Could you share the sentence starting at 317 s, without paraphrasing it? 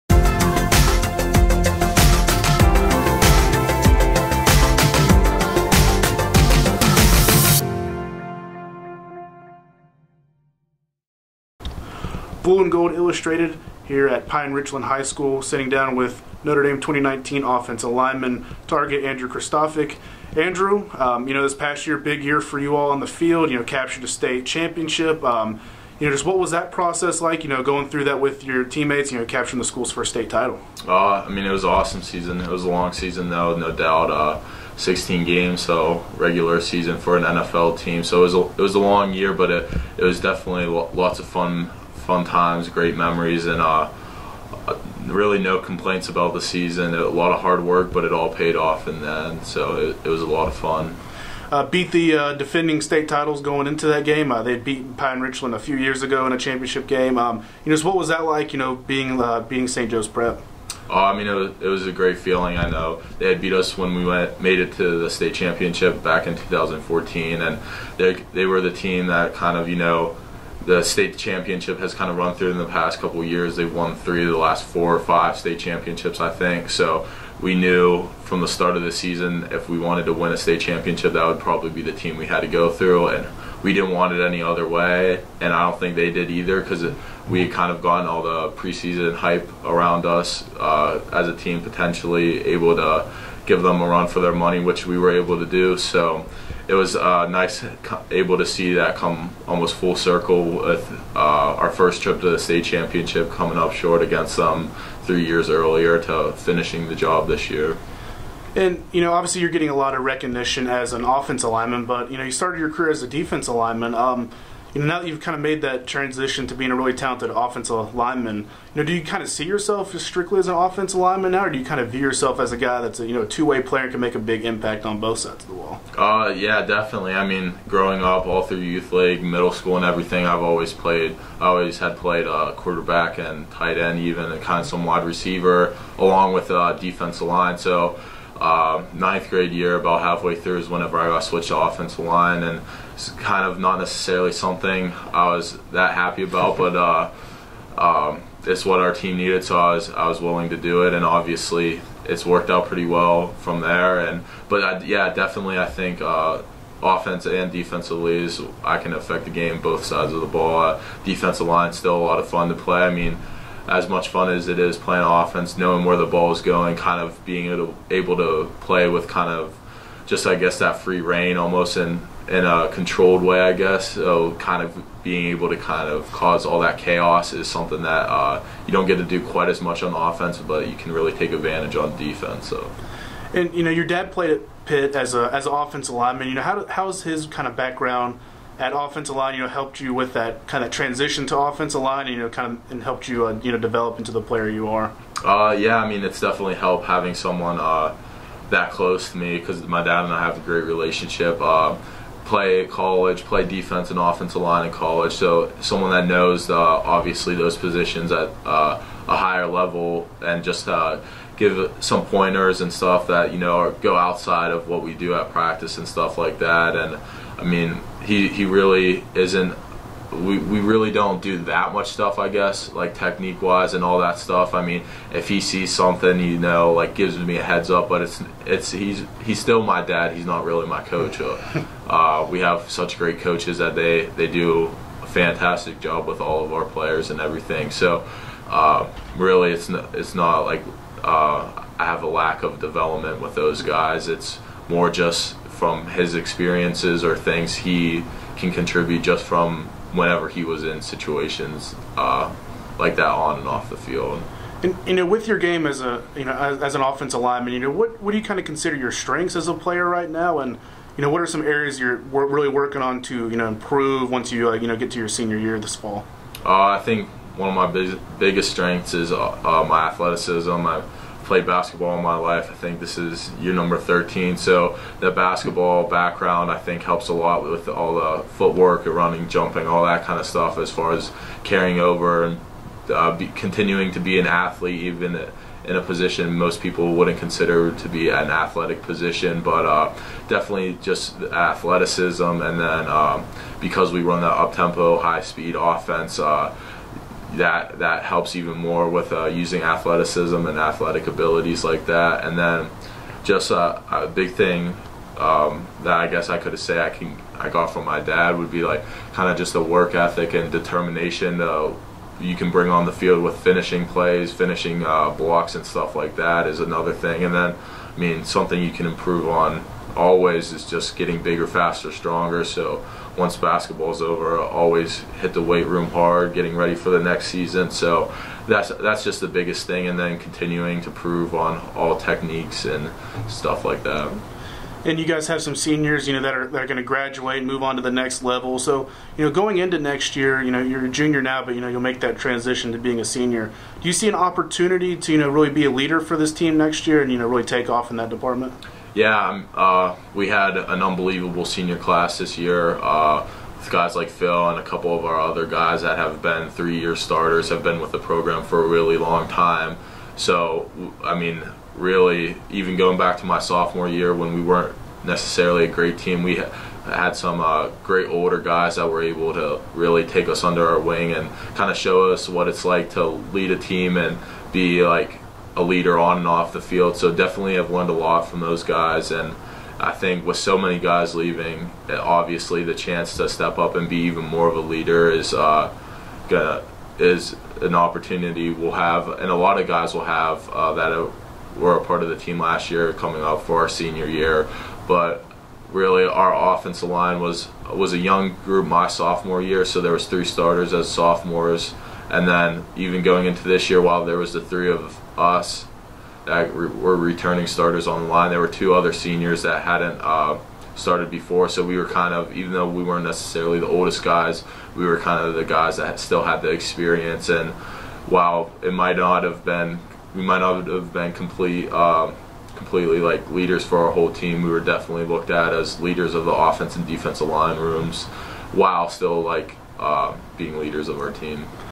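And then I mean something you can improve on always is just getting bigger, faster, stronger.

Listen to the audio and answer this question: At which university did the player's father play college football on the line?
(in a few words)
Pitt.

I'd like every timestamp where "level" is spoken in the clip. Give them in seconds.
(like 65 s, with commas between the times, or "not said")
209 s, 338 s.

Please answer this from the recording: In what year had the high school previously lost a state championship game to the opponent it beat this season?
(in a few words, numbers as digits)
2014.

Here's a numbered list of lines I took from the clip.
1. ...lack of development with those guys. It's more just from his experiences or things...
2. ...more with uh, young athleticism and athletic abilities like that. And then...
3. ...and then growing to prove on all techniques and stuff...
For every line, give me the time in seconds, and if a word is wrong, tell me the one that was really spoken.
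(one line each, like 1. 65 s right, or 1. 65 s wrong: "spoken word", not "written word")
1. 242 s right
2. 298 s wrong: "using", not "young"
3. 329 s wrong: "continuing", not "growing".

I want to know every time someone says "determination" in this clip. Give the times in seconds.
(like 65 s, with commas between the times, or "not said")
310 s.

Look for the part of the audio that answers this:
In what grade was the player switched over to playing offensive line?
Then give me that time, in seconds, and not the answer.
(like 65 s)
138 s.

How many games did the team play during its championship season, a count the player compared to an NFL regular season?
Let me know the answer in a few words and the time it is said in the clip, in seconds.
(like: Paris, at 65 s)
16, at 34 s.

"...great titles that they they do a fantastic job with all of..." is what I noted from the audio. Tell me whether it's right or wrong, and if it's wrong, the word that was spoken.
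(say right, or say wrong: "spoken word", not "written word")
wrong: "coaches", not "titles".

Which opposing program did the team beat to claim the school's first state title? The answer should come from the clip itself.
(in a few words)
St. Joe's Prep.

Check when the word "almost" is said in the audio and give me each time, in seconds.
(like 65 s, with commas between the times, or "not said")
99 s, 171 s.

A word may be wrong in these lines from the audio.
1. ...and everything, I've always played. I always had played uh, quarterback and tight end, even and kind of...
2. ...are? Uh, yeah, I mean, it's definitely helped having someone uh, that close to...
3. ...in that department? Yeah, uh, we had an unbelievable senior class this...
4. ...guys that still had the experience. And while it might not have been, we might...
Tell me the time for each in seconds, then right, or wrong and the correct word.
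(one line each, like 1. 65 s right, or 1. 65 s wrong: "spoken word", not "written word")
1. 129 s right
2. 194 s right
3. 347 s right
4. 415 s right.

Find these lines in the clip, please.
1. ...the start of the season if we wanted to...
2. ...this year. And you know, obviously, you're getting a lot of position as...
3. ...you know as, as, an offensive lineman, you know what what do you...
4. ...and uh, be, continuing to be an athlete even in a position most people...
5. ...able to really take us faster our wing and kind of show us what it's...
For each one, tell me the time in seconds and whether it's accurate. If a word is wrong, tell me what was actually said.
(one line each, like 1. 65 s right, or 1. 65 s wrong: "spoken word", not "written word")
1. 78 s right
2. 107 s wrong: "recognition", not "position"
3. 256 s right
4. 282 s right
5. 369 s wrong: "under", not "faster".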